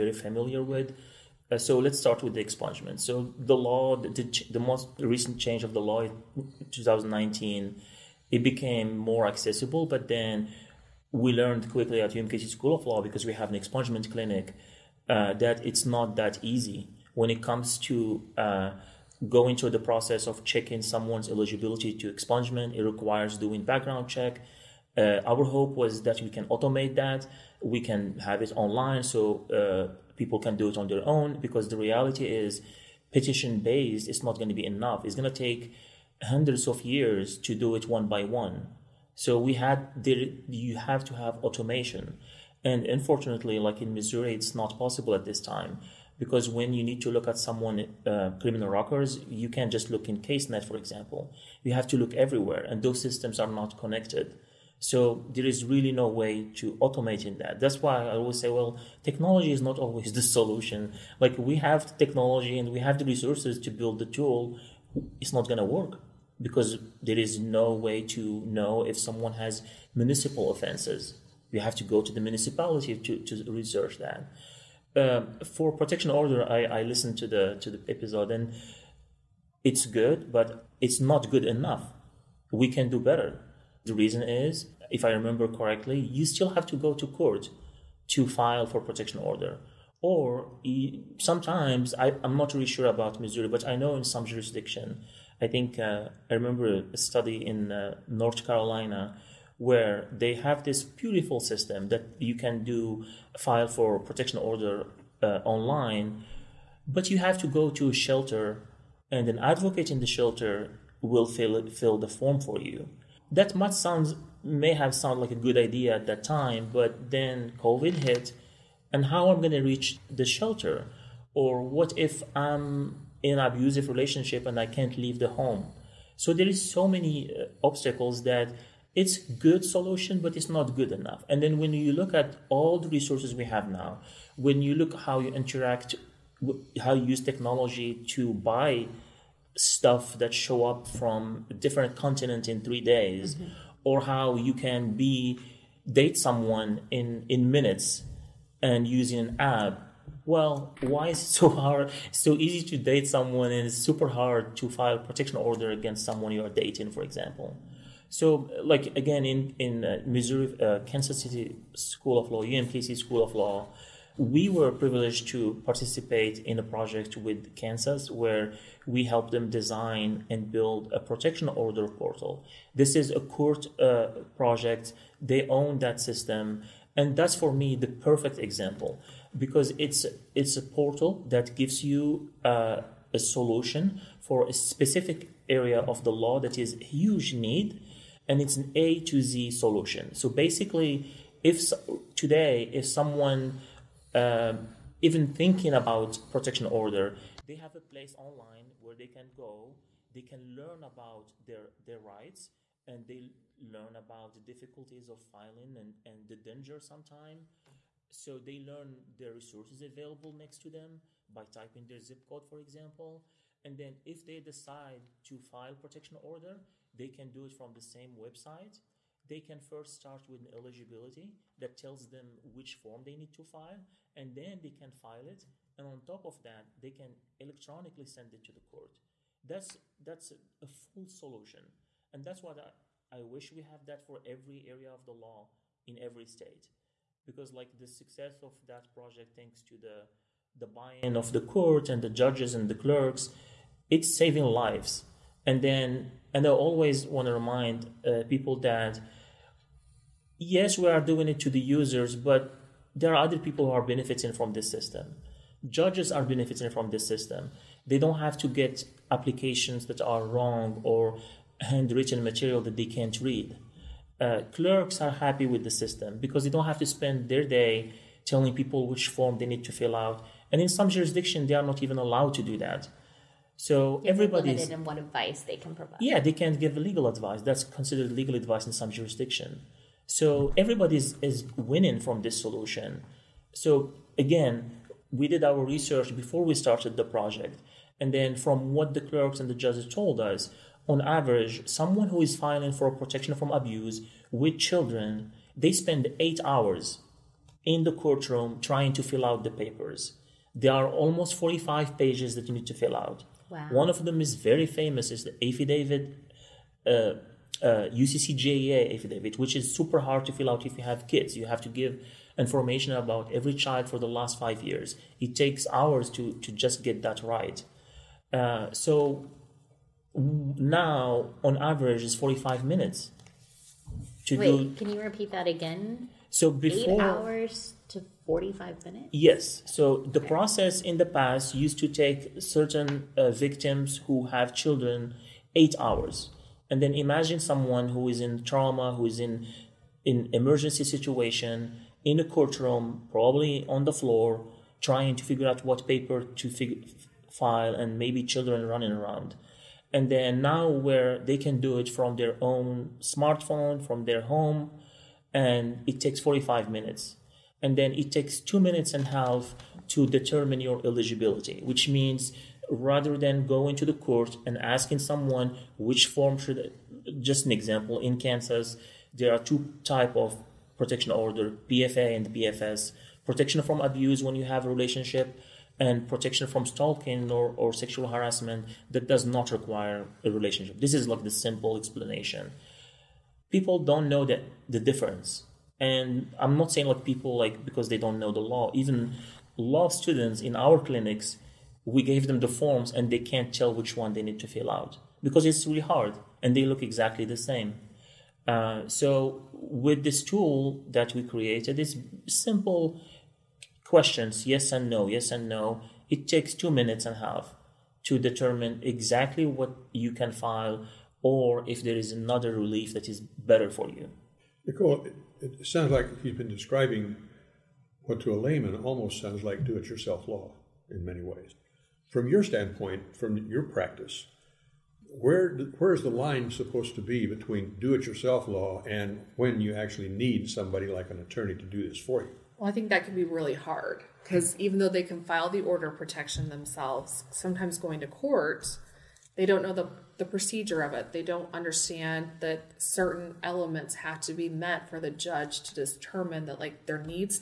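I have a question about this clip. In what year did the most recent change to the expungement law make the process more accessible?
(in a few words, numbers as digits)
2019.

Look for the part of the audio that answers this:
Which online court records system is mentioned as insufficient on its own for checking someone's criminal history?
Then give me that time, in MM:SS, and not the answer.
00:50.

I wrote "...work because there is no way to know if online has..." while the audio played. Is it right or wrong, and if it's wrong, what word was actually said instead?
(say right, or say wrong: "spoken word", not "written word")
wrong: "someone", not "online".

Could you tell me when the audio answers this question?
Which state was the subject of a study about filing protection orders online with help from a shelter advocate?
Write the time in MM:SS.
01:38.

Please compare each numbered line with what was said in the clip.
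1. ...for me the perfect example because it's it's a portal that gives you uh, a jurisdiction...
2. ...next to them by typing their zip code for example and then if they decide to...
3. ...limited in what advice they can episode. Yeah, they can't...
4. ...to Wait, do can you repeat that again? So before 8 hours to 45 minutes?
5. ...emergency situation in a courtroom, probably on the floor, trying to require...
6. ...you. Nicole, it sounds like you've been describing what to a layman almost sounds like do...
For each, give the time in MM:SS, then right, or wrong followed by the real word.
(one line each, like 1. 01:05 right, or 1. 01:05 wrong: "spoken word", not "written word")
1. 02:57 wrong: "solution", not "jurisdiction"
2. 03:30 right
3. 04:34 wrong: "provide", not "episode"
4. 05:24 right
5. 05:40 wrong: "figure", not "require"
6. 06:53 right.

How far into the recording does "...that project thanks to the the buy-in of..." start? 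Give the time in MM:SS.
03:58.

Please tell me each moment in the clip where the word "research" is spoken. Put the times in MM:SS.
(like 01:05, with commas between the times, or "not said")
01:13, 04:45.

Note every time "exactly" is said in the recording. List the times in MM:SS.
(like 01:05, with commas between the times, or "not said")
06:36, 06:48.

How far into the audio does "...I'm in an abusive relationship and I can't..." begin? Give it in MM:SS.
02:02.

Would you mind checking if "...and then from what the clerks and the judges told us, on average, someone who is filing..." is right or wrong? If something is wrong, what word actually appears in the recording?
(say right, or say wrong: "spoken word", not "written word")
right.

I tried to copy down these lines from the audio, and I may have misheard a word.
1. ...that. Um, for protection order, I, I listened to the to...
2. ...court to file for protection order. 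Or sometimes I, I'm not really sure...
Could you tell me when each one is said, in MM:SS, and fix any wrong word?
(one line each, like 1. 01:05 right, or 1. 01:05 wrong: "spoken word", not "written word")
1. 01:13 right
2. 01:27 right.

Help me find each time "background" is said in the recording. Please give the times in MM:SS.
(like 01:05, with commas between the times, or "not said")
00:23.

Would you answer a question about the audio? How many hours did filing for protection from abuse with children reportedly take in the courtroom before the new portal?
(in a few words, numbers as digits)
8 hours.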